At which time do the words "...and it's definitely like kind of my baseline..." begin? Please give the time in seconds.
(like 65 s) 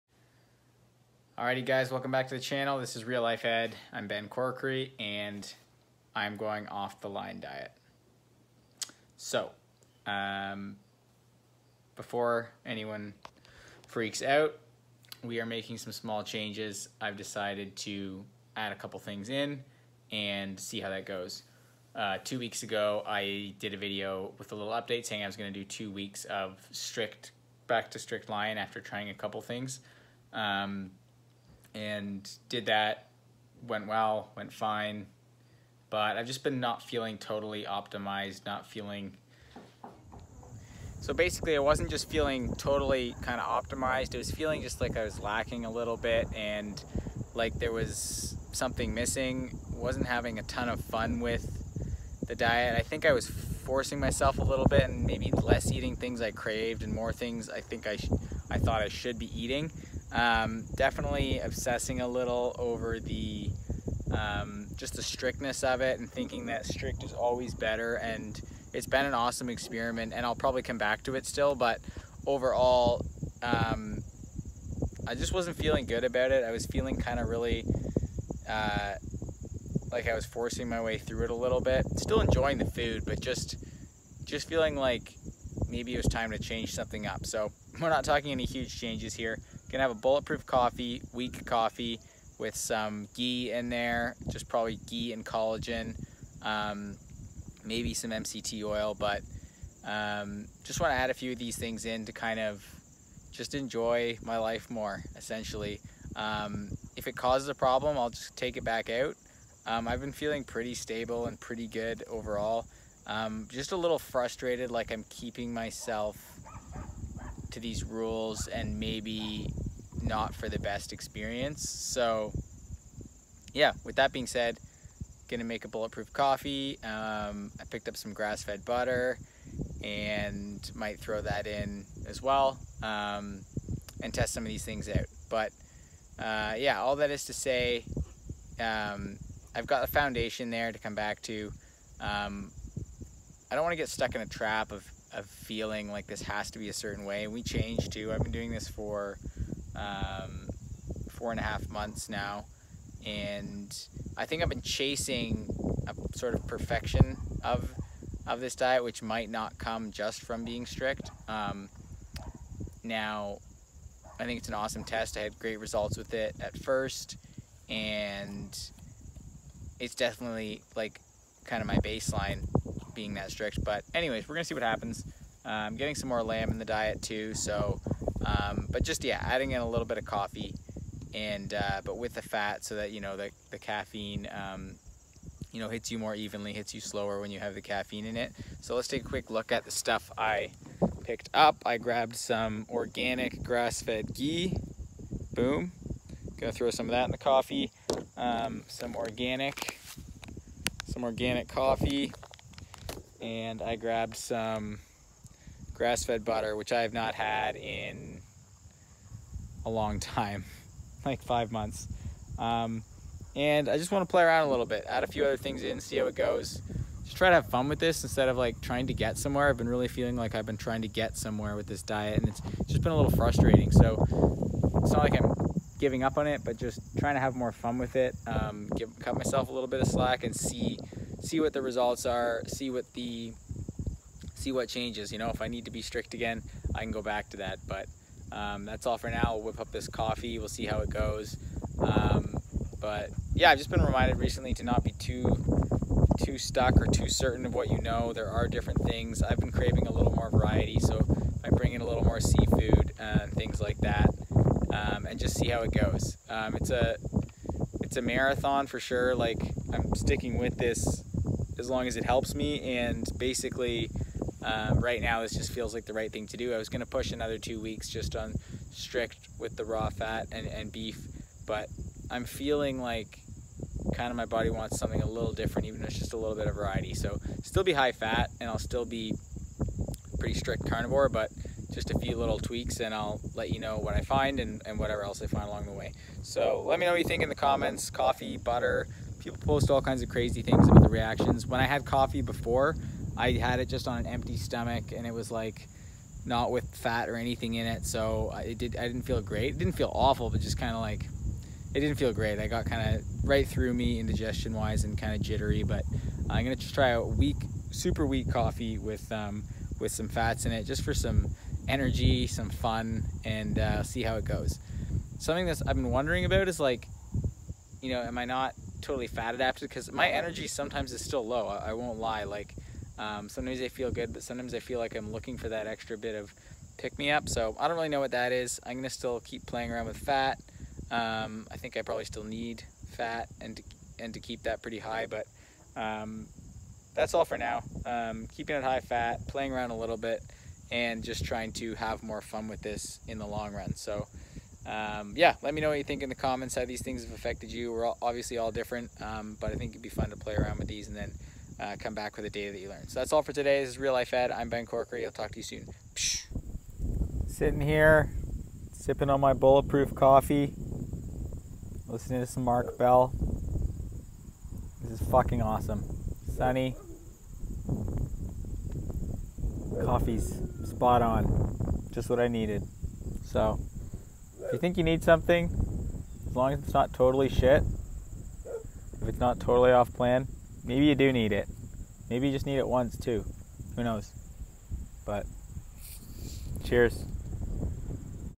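167 s.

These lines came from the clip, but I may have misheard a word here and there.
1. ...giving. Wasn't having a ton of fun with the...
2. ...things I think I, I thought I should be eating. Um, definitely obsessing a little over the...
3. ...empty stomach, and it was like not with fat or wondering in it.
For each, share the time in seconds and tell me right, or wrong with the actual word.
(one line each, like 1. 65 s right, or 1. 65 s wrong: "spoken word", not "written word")
1. 48 s wrong: "missing", not "giving"
2. 57 s right
3. 294 s wrong: "anything", not "wondering".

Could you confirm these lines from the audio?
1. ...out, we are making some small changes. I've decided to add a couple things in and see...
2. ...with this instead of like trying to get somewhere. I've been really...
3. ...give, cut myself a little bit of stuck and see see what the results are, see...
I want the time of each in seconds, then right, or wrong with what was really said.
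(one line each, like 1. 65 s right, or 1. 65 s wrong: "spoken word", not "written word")
1. 14 s right
2. 217 s right
3. 228 s wrong: "slack", not "stuck".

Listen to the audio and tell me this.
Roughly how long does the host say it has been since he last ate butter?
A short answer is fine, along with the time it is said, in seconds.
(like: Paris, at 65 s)
five months, at 211 s.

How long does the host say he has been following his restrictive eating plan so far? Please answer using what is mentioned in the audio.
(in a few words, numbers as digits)
four and a half months.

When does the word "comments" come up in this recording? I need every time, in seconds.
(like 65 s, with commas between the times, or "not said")
287 s, 346 s.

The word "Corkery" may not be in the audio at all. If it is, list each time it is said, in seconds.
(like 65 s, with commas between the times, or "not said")
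4 s, 354 s.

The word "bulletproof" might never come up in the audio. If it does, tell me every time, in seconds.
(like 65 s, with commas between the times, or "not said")
90 s, 125 s, 359 s.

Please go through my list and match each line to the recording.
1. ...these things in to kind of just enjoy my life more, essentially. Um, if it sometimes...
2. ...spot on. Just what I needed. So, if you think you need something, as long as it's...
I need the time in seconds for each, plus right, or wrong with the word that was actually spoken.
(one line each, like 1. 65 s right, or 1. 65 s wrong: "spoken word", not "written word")
1. 101 s wrong: "causes", not "sometimes"
2. 370 s right.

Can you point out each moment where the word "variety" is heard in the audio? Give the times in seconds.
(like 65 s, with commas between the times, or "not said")
250 s, 276 s.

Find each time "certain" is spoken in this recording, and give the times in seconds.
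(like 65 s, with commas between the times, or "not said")
146 s, 247 s.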